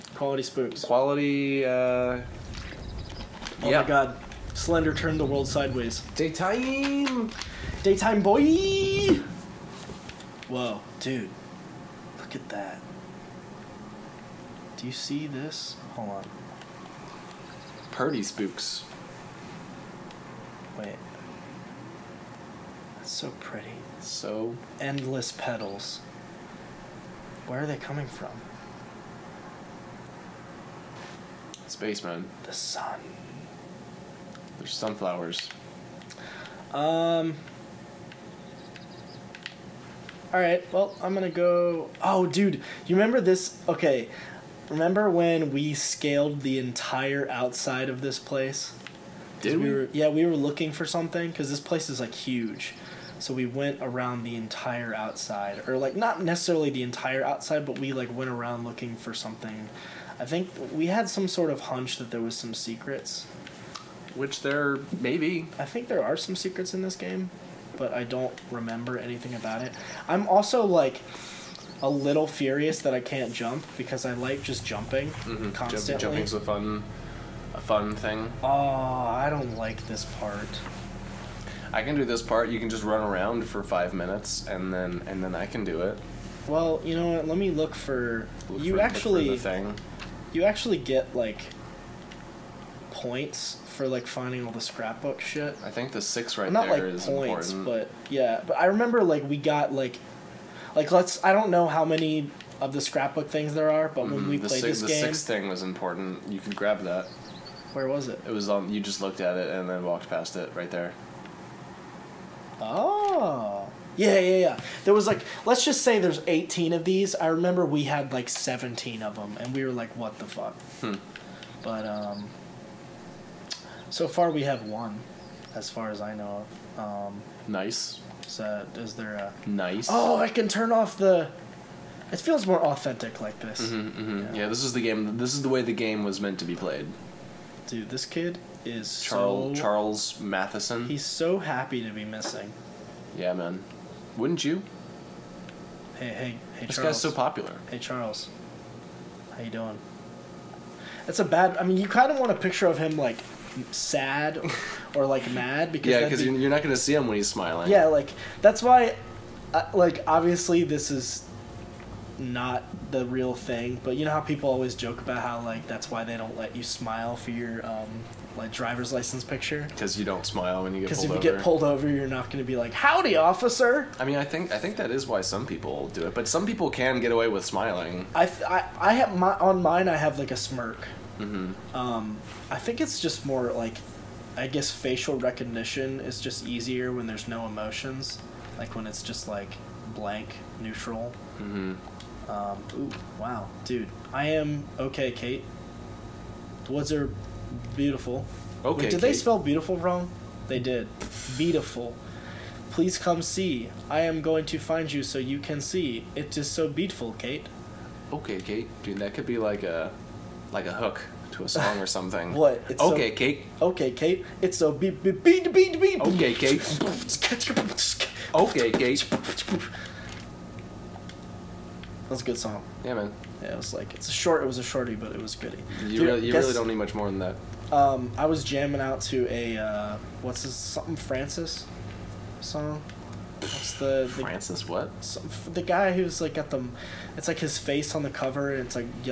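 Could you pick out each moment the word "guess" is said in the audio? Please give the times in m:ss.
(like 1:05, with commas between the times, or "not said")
3:04, 3:46.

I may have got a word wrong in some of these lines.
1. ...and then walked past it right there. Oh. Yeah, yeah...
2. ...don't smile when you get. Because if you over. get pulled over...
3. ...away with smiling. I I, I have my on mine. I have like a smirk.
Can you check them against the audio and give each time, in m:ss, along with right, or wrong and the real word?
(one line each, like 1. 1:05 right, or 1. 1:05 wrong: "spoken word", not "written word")
1. 1:49 right
2. 2:50 right
3. 2:57 right.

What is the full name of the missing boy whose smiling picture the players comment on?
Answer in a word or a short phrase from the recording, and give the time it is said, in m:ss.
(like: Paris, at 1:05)
Charles Matheson, at 2:19.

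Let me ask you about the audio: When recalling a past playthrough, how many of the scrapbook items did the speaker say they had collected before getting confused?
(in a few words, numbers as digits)
17.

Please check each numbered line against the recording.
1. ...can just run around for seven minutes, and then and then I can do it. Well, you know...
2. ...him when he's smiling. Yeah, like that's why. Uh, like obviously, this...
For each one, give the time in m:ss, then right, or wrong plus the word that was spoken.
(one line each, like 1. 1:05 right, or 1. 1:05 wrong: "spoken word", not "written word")
1. 1:22 wrong: "five", not "seven"
2. 2:36 right.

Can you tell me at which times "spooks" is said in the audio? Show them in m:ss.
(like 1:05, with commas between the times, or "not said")
0:00, 0:18.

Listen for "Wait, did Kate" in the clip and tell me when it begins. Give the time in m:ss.
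3:18.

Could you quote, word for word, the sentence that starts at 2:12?
It feels more authentic like this.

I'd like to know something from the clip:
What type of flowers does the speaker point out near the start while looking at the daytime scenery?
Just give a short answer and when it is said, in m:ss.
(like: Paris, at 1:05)
sunflowers, at 0:34.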